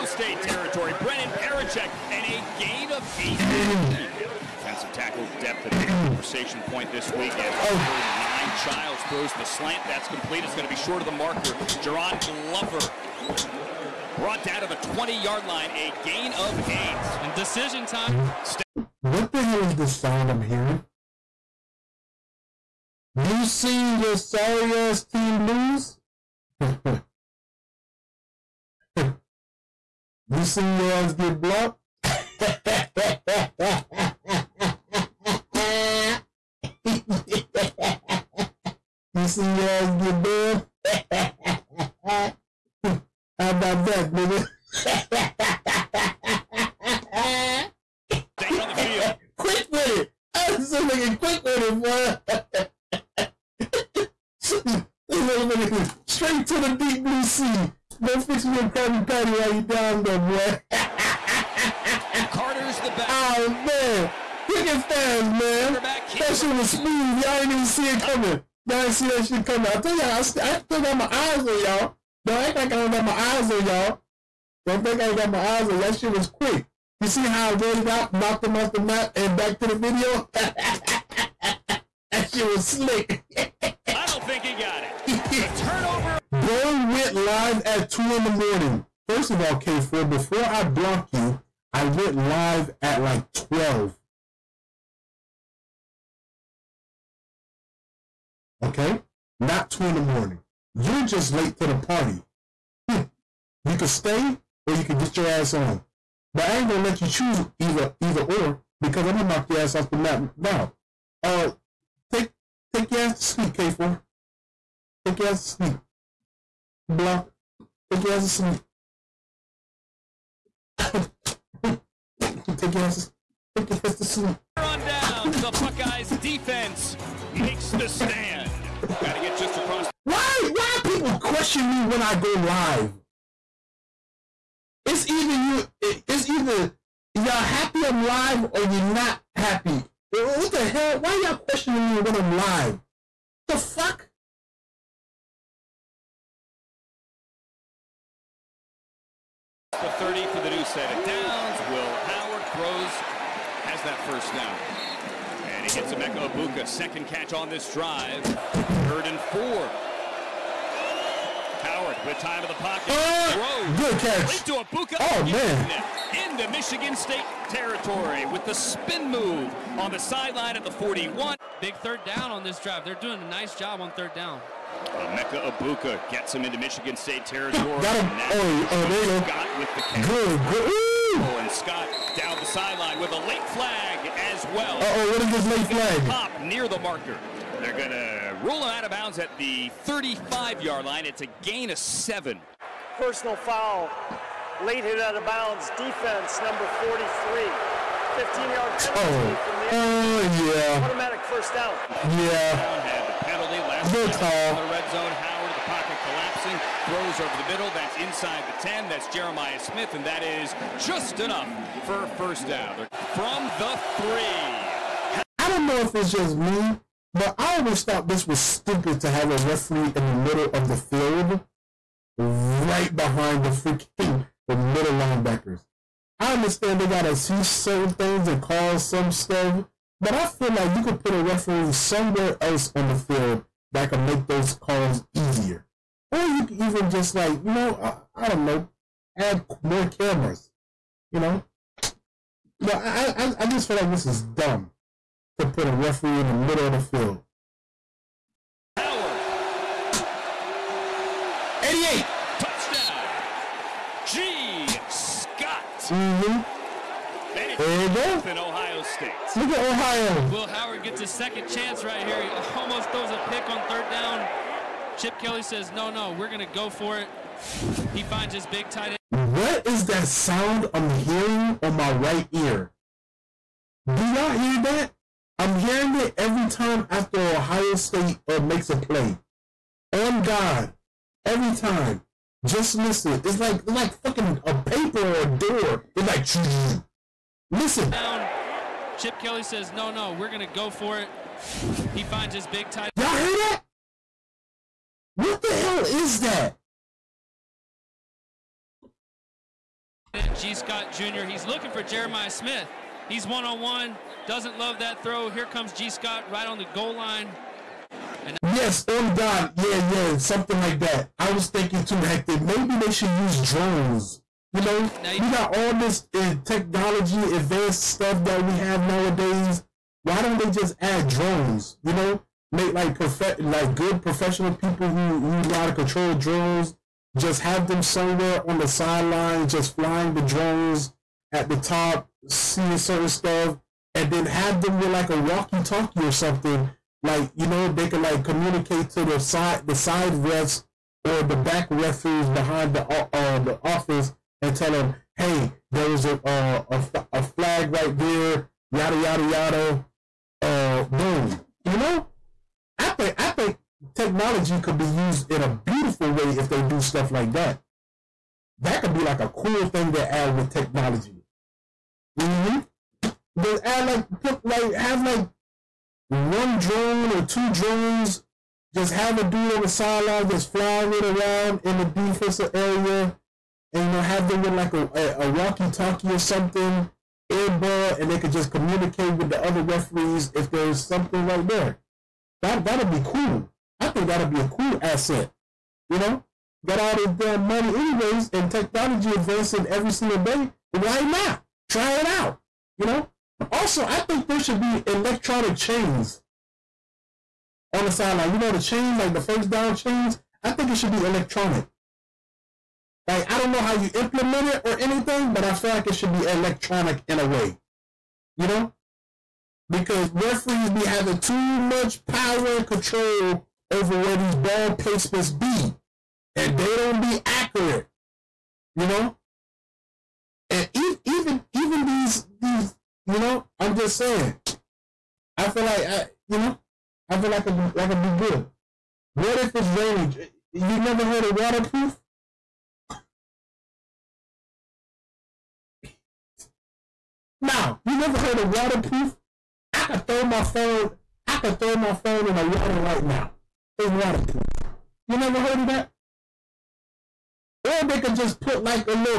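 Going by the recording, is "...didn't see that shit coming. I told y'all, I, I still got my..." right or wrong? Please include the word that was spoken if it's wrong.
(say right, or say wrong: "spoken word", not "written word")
right.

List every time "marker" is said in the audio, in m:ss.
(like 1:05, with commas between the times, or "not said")
0:11, 3:06.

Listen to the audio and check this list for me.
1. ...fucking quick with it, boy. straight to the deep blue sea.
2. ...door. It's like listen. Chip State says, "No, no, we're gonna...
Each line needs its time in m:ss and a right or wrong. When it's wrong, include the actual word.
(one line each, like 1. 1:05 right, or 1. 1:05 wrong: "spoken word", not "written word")
1. 0:50 right
2. 4:45 wrong: "Kelly", not "State".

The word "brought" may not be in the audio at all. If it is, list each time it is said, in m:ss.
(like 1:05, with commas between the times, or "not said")
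0:14.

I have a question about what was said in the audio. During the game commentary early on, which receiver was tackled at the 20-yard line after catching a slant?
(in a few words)
Jerron Glover.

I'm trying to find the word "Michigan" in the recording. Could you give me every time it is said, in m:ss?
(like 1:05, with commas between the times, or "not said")
2:46, 2:56.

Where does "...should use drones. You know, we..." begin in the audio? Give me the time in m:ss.
5:12.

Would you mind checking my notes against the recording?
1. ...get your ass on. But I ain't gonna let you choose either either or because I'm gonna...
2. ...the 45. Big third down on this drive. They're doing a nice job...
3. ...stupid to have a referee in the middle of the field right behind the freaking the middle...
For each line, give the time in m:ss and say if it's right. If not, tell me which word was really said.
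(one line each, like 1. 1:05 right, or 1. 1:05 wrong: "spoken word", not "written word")
1. 1:44 right
2. 2:50 wrong: "41", not "45"
3. 3:38 right.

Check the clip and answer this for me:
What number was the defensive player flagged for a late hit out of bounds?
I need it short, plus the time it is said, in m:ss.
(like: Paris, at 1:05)
43, at 3:16.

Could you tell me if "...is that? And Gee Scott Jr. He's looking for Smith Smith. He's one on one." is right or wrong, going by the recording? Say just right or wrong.
wrong.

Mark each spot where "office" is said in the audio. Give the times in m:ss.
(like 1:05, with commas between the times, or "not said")
5:43.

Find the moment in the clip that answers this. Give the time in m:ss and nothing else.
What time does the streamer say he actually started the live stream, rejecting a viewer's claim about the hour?
1:33.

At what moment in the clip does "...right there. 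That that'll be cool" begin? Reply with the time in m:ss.
6:21.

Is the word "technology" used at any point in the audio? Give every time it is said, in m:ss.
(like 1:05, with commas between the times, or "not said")
5:16, 5:53, 6:00, 6:28.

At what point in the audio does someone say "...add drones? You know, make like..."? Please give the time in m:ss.
5:20.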